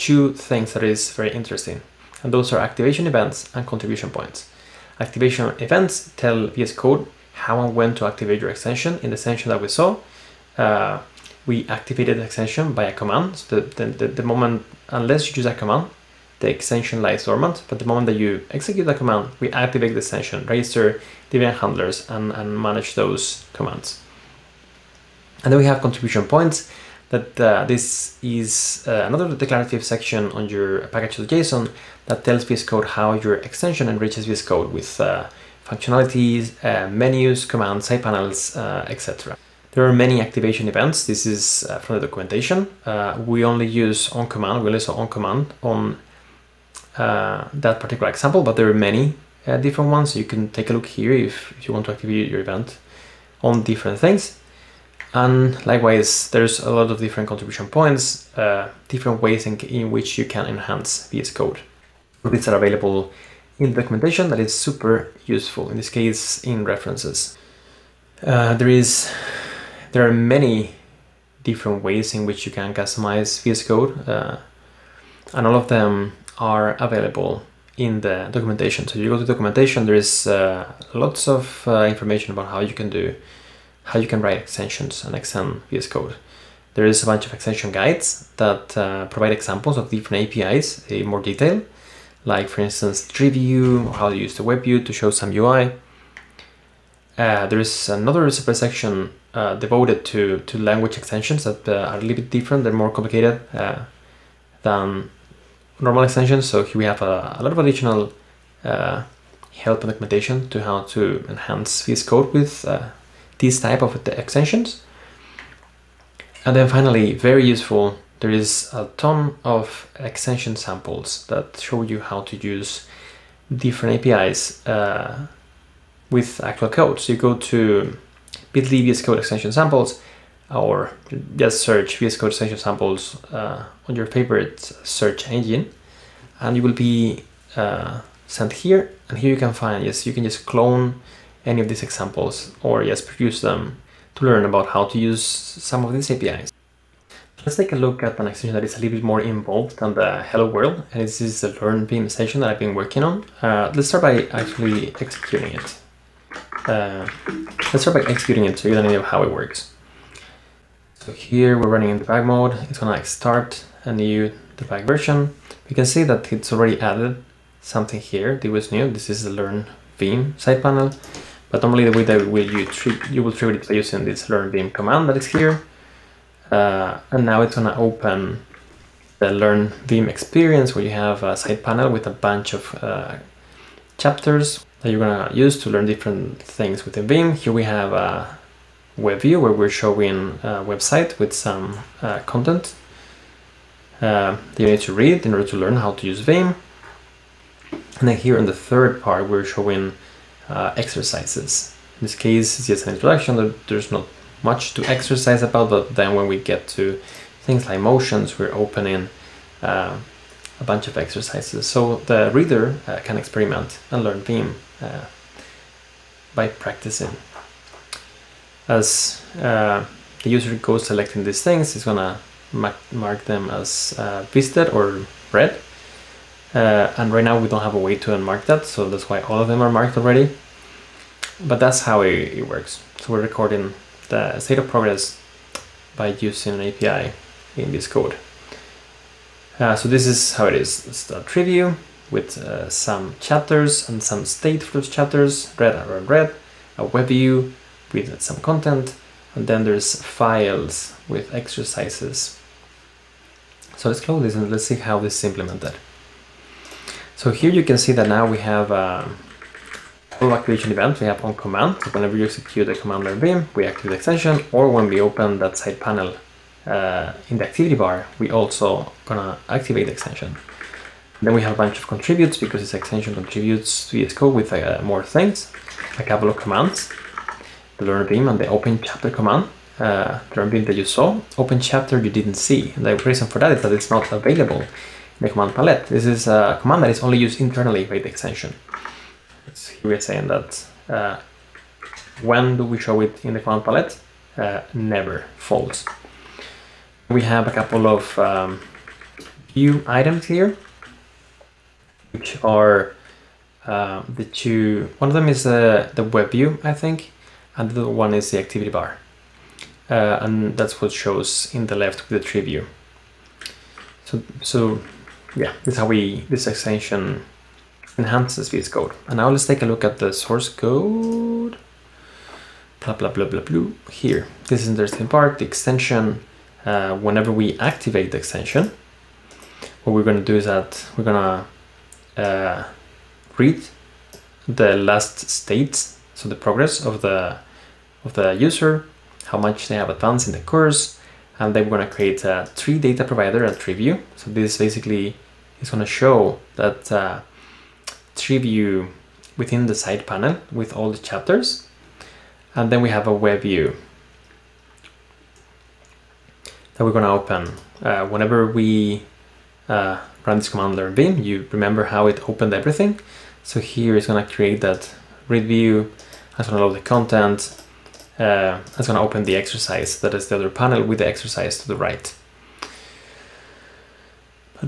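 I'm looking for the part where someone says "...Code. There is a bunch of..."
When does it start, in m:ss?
1:25.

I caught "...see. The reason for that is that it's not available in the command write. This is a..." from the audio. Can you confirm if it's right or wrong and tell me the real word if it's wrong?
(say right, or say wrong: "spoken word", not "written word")
wrong: "palette", not "write".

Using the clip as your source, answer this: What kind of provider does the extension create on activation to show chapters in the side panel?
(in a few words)
tree data provider.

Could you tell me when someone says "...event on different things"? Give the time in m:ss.
0:52.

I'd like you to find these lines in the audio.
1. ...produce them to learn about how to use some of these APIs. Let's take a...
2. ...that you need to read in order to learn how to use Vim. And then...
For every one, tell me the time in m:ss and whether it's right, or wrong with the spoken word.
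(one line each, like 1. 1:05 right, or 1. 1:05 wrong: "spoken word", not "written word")
1. 2:23 right
2. 3:14 right.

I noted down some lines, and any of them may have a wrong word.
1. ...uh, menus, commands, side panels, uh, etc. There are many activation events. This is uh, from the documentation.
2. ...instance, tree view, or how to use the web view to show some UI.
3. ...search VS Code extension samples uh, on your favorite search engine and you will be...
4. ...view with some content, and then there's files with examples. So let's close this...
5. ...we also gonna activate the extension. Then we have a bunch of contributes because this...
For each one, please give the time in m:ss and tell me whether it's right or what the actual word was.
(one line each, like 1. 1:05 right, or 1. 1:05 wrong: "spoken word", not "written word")
1. 0:36 right
2. 1:32 right
3. 2:11 right
4. 4:07 wrong: "exercises", not "examples"
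5. 4:28 right.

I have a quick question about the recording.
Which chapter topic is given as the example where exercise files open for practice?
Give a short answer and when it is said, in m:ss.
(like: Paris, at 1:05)
motions, at 3:27.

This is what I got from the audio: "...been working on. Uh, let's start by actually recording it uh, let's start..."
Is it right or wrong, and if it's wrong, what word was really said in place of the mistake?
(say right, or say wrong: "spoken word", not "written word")
wrong: "executing", not "recording".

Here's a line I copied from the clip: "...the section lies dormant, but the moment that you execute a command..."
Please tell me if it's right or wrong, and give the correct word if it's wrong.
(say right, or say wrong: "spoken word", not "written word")
wrong: "extension", not "section".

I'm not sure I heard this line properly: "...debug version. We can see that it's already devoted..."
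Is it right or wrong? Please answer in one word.
wrong.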